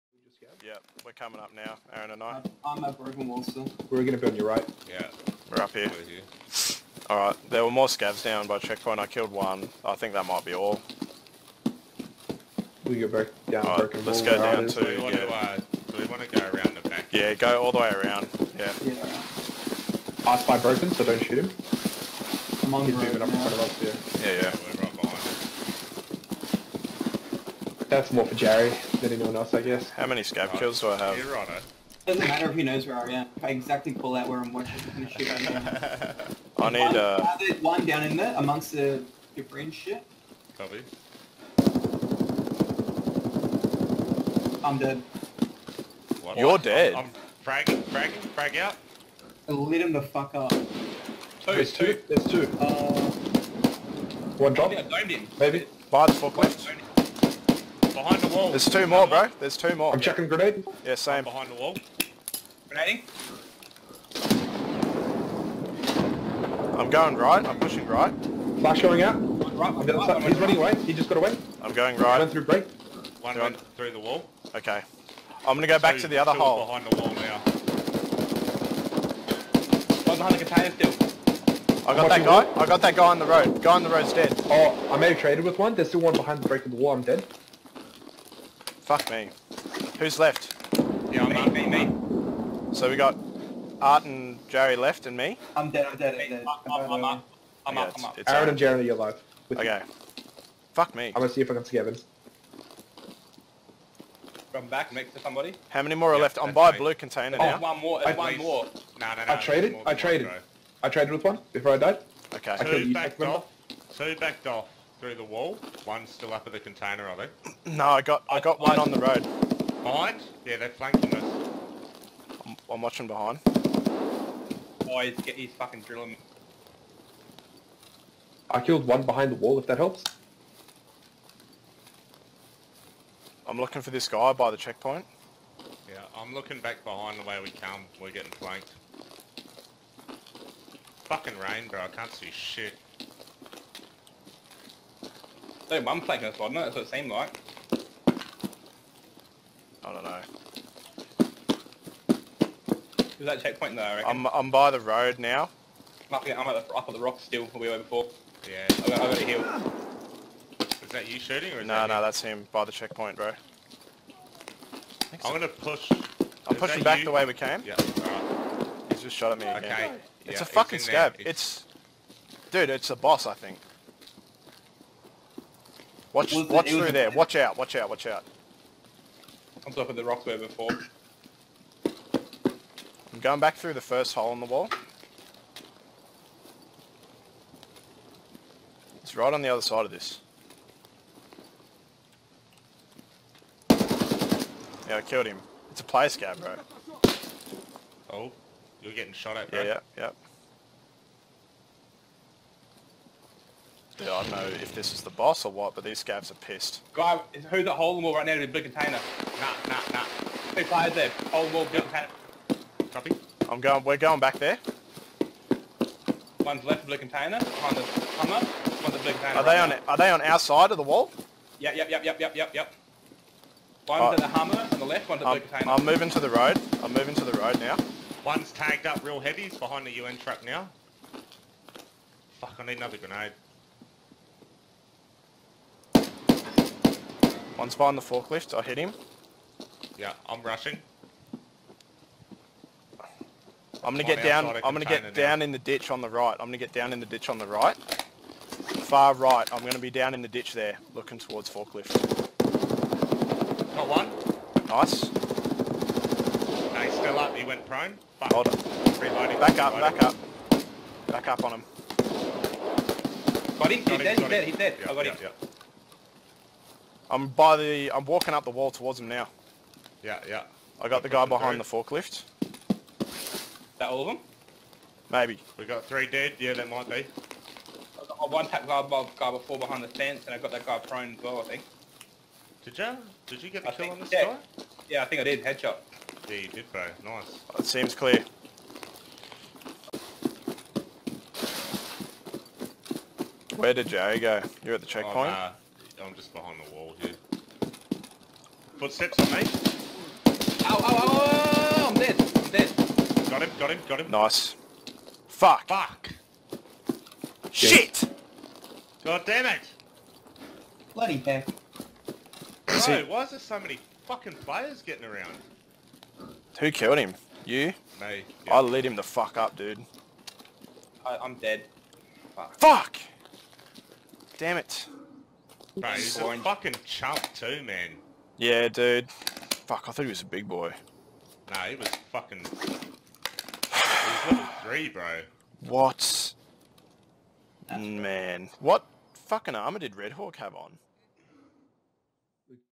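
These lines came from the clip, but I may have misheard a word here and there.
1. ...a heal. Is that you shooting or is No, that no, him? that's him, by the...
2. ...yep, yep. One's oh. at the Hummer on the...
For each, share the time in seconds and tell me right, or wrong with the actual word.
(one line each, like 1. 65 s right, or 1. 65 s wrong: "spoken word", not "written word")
1. 159 s right
2. 222 s right.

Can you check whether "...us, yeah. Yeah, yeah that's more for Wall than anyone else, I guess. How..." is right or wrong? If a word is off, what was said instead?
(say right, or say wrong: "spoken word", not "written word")
wrong: "Jerry", not "Wall".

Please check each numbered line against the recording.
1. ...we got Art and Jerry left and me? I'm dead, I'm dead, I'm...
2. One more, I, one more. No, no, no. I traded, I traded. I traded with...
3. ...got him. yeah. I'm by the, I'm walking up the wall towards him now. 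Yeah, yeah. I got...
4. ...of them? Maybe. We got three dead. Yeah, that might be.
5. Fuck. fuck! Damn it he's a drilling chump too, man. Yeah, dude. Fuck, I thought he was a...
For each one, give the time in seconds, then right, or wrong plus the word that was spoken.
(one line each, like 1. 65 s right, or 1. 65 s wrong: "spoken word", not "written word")
1. 92 s right
2. 107 s right
3. 264 s right
4. 274 s right
5. 322 s wrong: "fucking", not "drilling".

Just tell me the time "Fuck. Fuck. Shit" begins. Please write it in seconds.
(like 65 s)
305 s.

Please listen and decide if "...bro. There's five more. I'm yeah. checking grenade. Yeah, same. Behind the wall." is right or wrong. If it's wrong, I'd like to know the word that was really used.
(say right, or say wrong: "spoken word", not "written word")
wrong: "two", not "five".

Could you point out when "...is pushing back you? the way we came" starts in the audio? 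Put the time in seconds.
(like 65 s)
166 s.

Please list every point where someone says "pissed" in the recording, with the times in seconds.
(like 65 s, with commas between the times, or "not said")
206 s.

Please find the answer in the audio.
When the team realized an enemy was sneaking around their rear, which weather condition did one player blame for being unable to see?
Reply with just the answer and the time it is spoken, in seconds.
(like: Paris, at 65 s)
Rain, at 141 s.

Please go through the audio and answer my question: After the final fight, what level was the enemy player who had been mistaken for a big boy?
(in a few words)
Level 3.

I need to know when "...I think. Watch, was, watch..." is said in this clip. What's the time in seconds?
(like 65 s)
173 s.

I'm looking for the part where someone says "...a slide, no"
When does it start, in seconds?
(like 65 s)
146 s.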